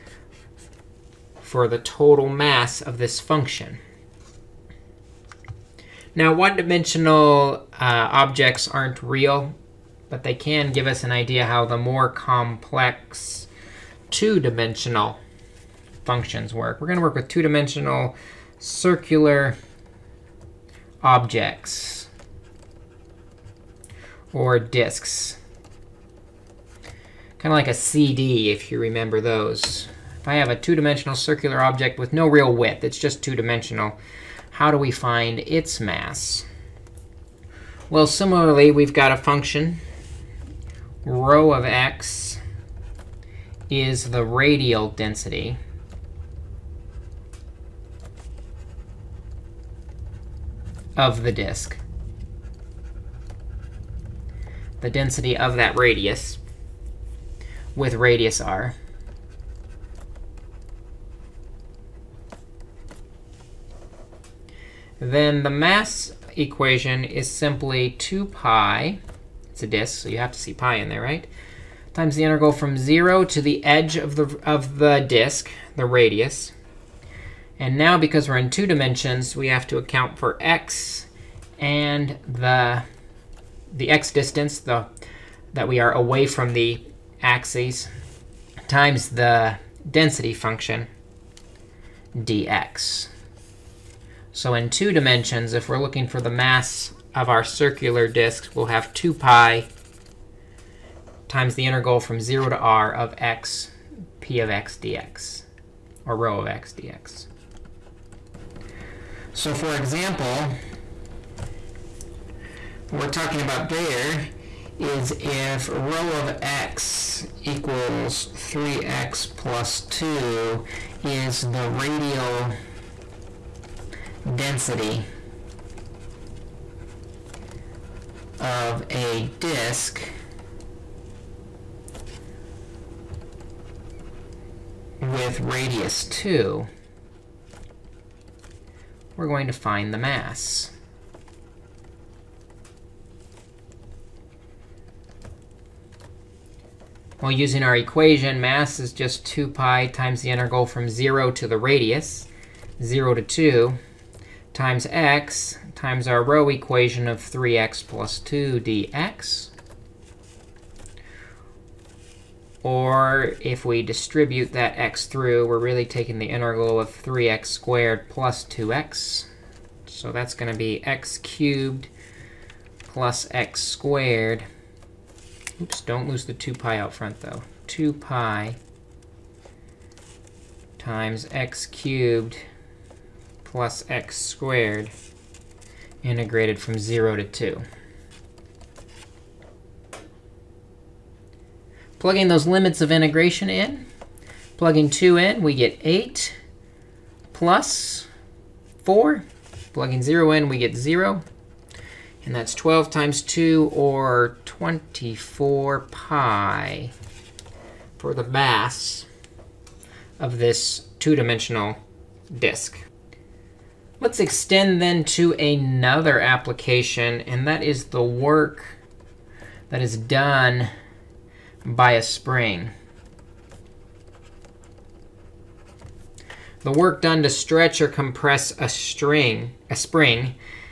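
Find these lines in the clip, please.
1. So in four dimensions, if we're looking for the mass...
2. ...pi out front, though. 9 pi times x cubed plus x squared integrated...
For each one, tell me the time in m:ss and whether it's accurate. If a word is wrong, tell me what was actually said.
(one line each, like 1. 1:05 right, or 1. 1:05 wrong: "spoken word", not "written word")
1. 1:34 wrong: "two", not "four"
2. 2:56 wrong: "2", not "9".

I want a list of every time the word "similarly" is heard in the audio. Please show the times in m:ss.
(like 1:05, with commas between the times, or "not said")
0:38.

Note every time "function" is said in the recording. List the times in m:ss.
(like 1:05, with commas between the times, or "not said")
0:03, 0:16, 0:39, 1:30.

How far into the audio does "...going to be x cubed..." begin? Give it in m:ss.
2:50.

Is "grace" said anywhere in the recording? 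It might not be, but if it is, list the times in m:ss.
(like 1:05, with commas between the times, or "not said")
not said.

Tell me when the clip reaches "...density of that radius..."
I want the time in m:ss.
0:54.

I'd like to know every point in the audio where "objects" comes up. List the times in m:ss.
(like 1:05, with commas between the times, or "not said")
0:08, 0:21, 0:31.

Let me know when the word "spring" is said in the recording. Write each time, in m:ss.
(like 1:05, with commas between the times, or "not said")
3:42, 3:49.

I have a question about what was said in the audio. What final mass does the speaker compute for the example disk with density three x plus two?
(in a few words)
24 pi.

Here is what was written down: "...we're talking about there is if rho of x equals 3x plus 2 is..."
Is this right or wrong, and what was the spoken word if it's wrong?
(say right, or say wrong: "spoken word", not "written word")
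right.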